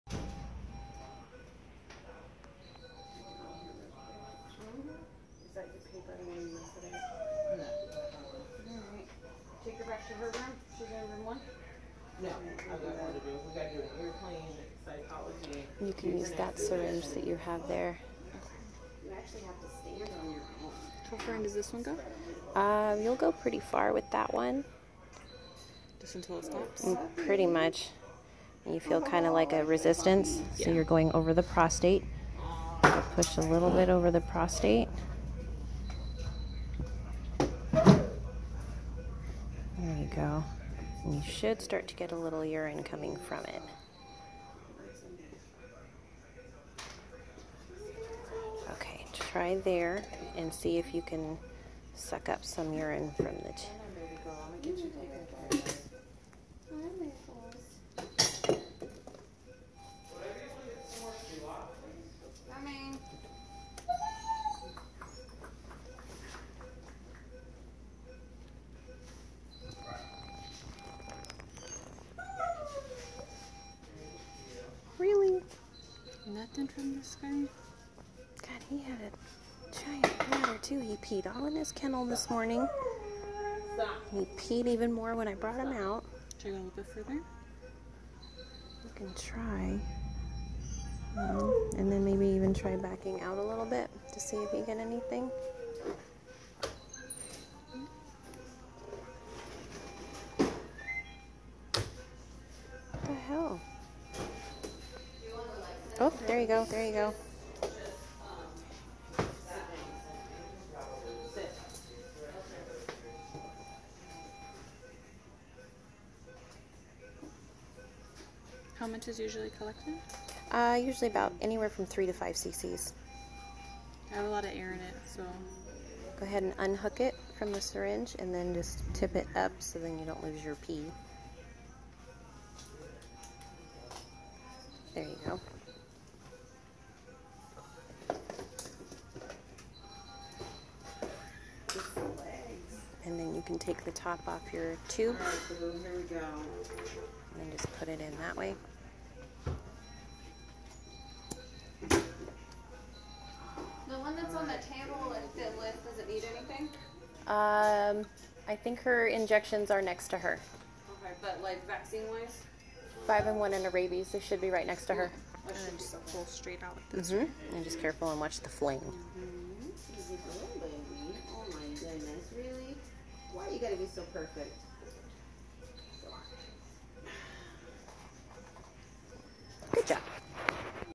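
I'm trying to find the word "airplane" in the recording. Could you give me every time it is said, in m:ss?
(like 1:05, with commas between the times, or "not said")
0:14.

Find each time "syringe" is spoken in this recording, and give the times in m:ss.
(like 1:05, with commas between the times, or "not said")
0:16, 2:07.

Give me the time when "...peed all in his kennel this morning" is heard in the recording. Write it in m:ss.
1:20.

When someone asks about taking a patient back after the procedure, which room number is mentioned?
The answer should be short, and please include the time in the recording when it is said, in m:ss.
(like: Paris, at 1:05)
1, at 0:11.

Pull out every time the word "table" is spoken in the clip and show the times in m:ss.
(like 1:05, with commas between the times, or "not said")
2:34.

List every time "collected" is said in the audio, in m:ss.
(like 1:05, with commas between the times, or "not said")
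1:59.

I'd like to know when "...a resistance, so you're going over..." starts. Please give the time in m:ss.
0:29.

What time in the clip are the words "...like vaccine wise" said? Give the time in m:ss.
2:41.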